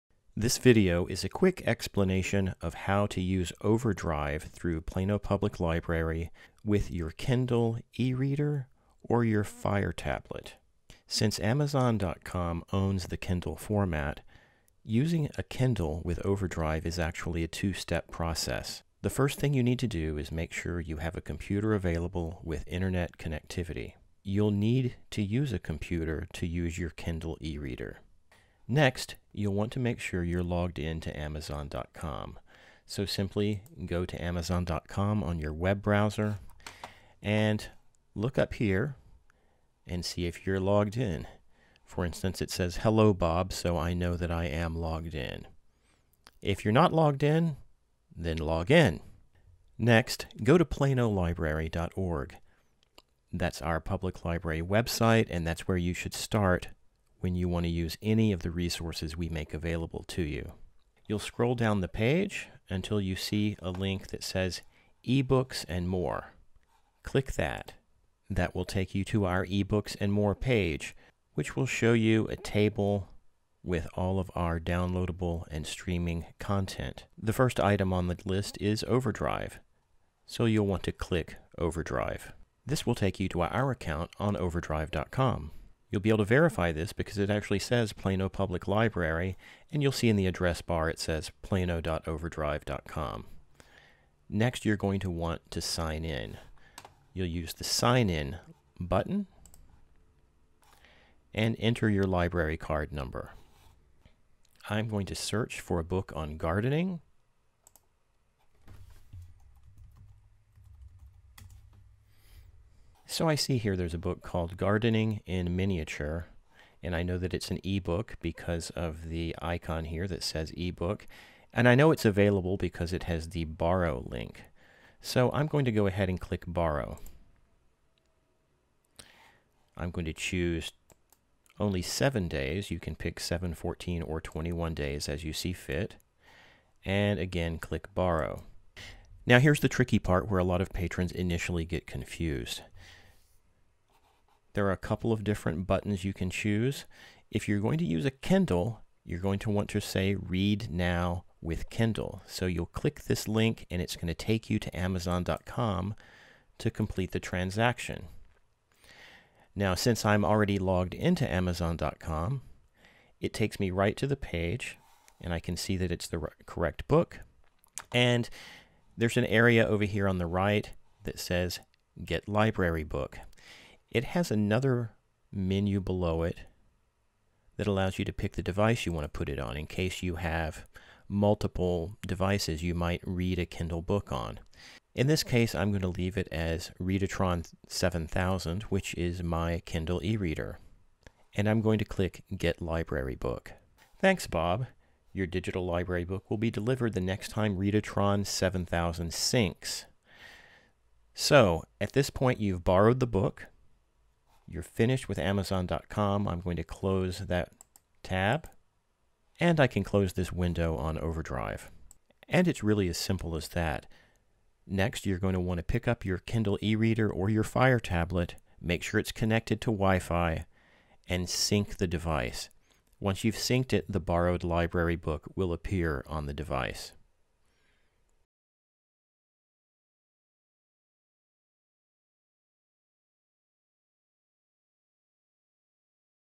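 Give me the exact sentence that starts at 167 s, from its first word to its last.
And there's an area over here on the right that says Get Library Book.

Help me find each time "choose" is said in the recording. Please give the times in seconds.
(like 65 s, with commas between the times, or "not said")
130 s, 146 s.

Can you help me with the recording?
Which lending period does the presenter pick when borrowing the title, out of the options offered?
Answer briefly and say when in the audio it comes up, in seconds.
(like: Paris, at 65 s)
7 days, at 131 s.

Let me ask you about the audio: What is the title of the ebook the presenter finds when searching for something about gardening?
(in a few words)
Gardening in Miniature.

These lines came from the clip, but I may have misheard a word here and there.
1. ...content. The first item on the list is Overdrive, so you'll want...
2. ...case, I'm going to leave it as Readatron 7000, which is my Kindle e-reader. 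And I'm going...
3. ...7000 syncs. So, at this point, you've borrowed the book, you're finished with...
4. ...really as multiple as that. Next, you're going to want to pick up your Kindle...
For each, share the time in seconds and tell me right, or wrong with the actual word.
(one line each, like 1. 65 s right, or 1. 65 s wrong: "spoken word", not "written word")
1. 76 s right
2. 185 s right
3. 198 s right
4. 212 s wrong: "simple", not "multiple".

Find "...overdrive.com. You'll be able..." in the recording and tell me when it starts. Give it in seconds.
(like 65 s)
84 s.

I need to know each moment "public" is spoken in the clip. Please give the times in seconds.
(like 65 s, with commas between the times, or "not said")
5 s, 53 s, 88 s.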